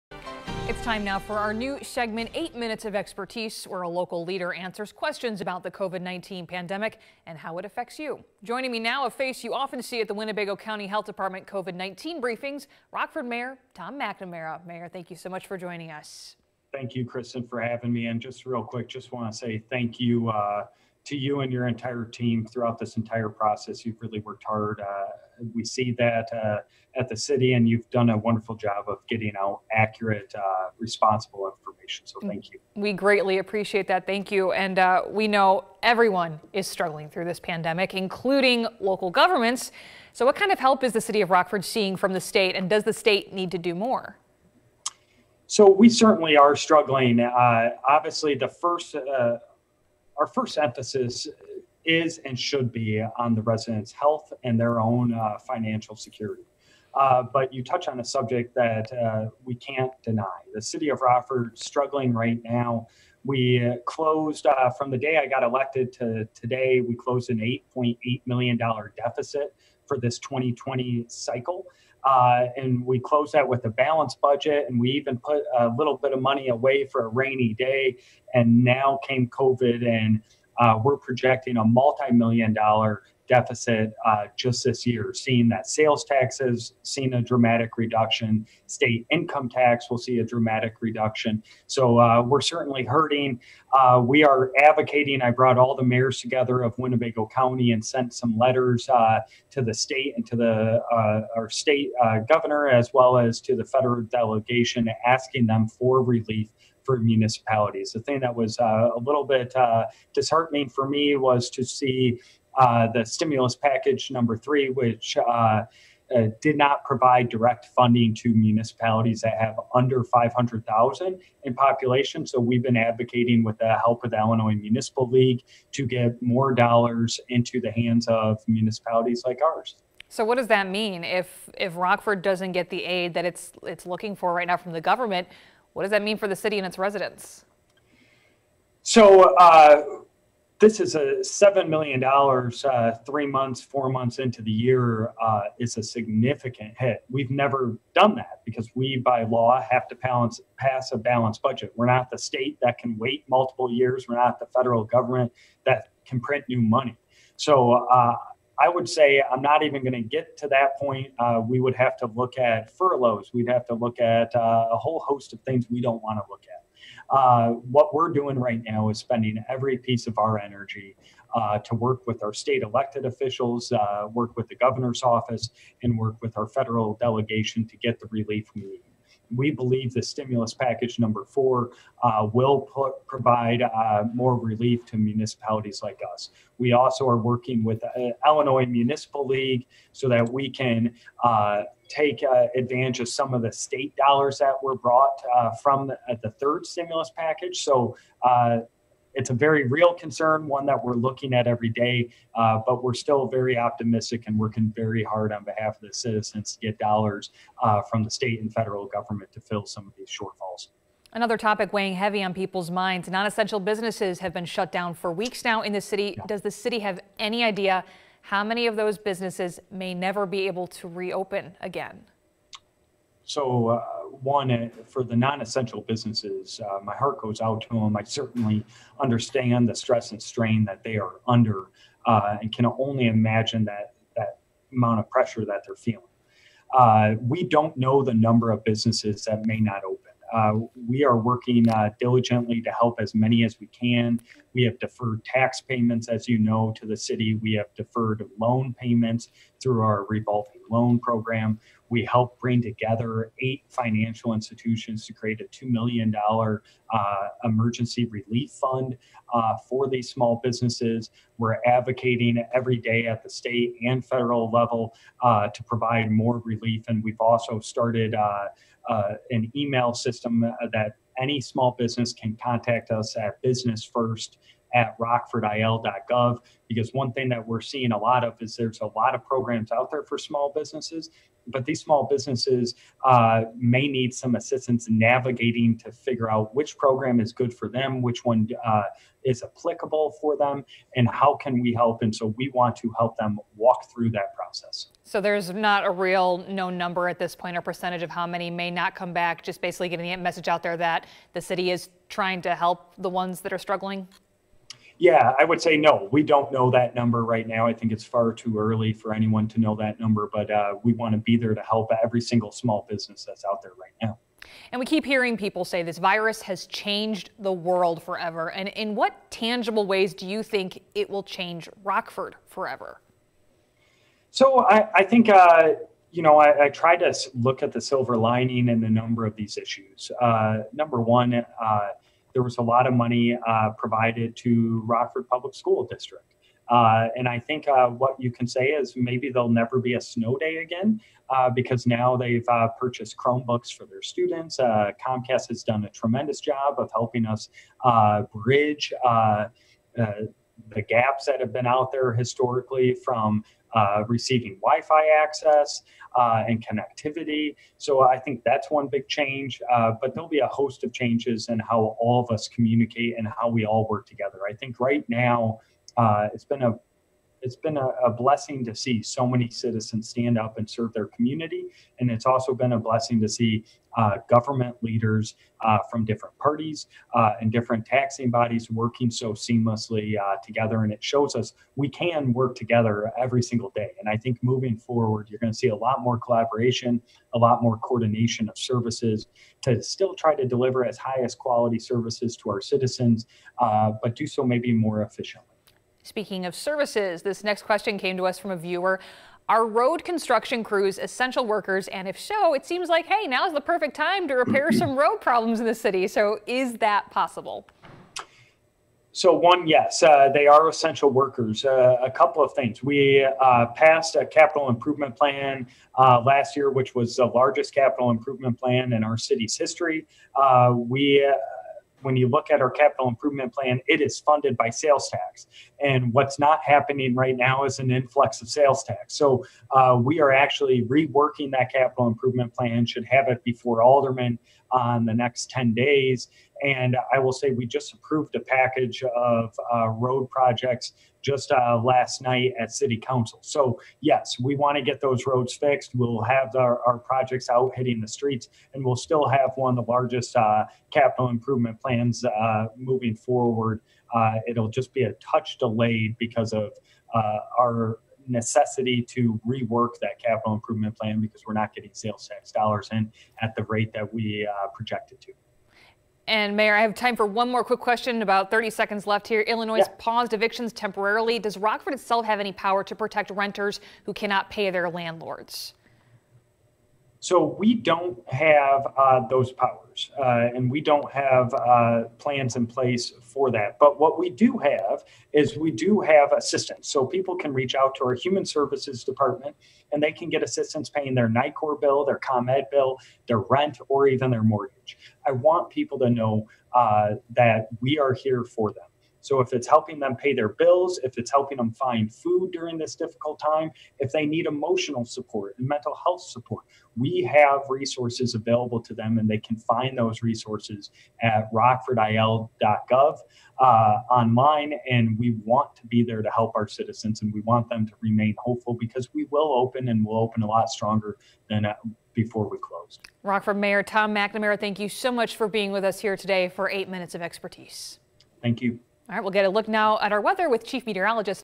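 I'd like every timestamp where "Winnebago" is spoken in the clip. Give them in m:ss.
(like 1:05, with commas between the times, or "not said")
0:10, 1:36.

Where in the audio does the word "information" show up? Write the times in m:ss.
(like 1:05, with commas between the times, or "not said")
0:31.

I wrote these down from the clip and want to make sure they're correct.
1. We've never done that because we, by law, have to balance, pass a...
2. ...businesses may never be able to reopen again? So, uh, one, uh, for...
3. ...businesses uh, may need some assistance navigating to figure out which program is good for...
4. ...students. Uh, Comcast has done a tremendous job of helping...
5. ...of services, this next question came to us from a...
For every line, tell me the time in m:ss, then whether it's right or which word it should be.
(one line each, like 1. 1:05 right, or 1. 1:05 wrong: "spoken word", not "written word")
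1. 2:27 right
2. 3:38 right
3. 4:42 right
4. 5:44 right
5. 6:36 right.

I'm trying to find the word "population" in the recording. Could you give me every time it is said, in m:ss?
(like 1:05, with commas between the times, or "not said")
2:01.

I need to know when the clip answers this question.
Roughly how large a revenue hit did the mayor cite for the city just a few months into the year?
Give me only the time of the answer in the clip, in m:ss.
2:21.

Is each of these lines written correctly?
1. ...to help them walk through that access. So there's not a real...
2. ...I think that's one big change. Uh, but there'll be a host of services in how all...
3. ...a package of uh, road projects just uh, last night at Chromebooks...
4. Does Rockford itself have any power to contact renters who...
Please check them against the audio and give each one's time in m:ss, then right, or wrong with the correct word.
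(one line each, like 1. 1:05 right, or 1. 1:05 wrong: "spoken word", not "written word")
1. 4:52 wrong: "process", not "access"
2. 5:58 wrong: "changes", not "services"
3. 7:18 wrong: "City", not "Chromebooks"
4. 7:51 wrong: "protect", not "contact".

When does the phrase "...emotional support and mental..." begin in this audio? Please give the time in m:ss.
8:24.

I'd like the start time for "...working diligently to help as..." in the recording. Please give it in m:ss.
4:01.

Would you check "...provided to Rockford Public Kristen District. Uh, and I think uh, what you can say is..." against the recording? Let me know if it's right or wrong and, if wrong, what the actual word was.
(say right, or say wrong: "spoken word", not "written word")
wrong: "School", not "Kristen".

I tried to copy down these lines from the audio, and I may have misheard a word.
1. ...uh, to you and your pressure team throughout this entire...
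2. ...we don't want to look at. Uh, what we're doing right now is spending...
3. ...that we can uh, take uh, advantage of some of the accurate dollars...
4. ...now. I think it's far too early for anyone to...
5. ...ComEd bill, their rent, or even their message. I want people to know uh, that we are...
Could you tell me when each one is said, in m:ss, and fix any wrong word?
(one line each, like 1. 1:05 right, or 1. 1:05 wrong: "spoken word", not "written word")
1. 0:20 wrong: "entire", not "pressure"
2. 2:45 right
3. 3:10 wrong: "state", not "accurate"
4. 5:07 right
5. 8:12 wrong: "mortgage", not "message".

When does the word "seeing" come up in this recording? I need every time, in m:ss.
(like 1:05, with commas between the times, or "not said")
0:41, 1:25, 4:37.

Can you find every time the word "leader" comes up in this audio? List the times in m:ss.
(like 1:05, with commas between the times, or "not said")
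0:04, 6:14.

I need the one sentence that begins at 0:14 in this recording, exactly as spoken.
Mayor, thank you so much for joining us.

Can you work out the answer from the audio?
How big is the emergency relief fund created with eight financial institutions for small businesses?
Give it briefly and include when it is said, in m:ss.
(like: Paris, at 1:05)
$2 million, at 4:15.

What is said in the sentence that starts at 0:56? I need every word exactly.
Uh, but you touch on a subject that uh, we can't deny.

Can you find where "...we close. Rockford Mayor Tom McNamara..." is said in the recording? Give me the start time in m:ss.
8:42.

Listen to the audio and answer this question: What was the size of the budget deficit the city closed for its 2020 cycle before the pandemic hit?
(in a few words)
$8.8 million.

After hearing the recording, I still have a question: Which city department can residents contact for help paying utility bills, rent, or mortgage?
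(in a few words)
human services department.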